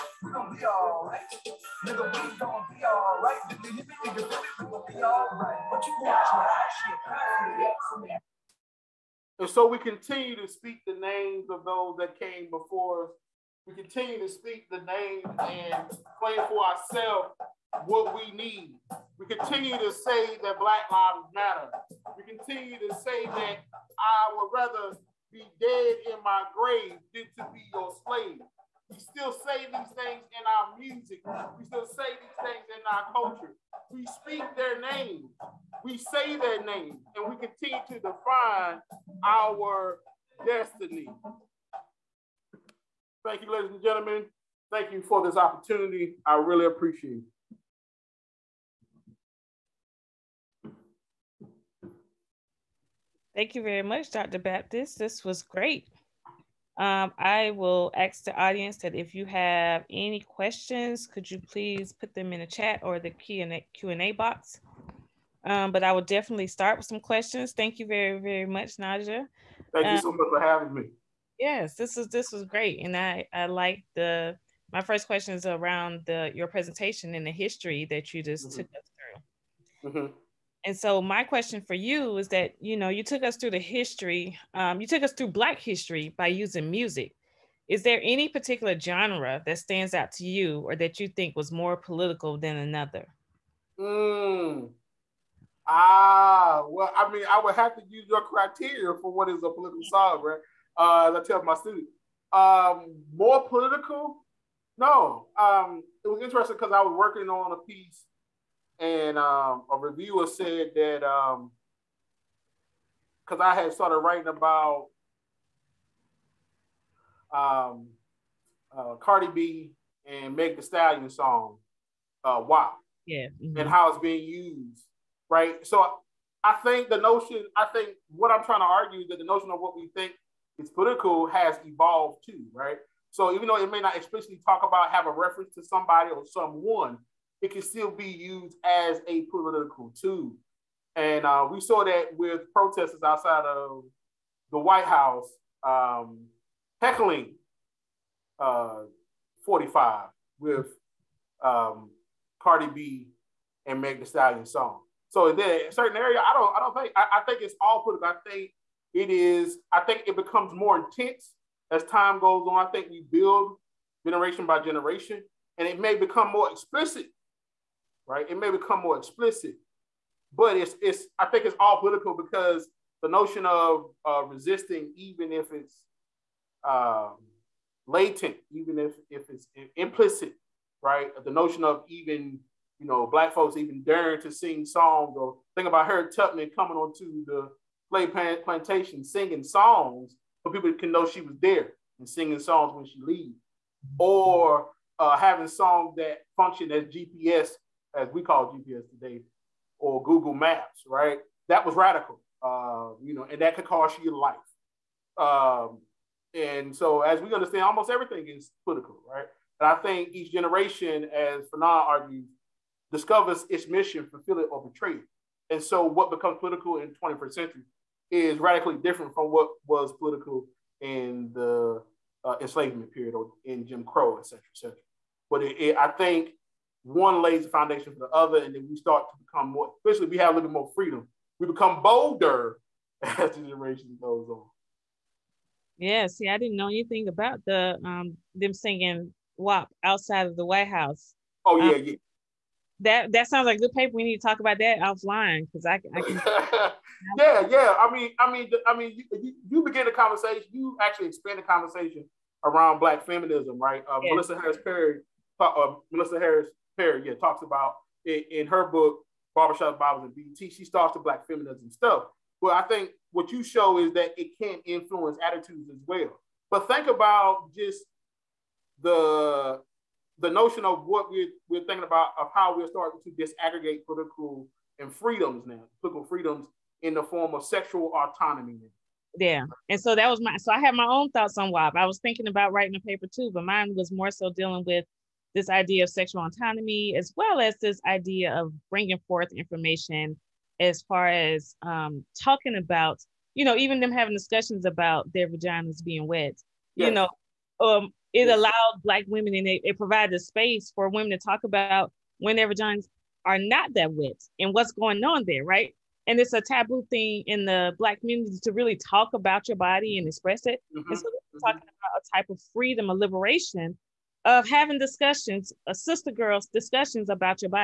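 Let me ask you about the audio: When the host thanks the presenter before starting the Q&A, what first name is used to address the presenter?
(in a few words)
Najja.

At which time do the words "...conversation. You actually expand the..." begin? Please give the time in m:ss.
4:09.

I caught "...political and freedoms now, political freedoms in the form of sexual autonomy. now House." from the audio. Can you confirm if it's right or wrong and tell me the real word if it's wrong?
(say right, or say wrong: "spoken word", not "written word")
wrong: "Yeah", not "House".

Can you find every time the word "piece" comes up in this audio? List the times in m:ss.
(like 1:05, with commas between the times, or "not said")
1:47.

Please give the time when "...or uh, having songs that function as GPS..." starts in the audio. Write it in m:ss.
3:13.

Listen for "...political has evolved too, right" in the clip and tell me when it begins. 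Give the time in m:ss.
2:10.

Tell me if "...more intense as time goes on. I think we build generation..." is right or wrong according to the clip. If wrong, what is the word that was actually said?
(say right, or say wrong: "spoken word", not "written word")
right.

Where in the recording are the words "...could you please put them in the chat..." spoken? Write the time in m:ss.
1:01.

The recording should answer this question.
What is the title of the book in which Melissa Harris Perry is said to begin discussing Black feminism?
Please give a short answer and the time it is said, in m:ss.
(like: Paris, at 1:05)
Barbershop Bibles and BET, at 4:19.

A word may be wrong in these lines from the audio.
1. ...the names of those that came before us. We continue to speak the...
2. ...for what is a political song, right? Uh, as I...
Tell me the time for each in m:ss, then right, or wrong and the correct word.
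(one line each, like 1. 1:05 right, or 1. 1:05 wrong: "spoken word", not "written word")
1. 0:10 right
2. 1:39 right.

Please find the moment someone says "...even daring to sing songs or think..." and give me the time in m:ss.
3:03.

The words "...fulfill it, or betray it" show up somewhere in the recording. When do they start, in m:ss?
3:34.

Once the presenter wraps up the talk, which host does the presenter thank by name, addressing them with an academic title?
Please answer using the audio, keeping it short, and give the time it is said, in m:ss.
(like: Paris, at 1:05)
Dr. Baptist, at 0:54.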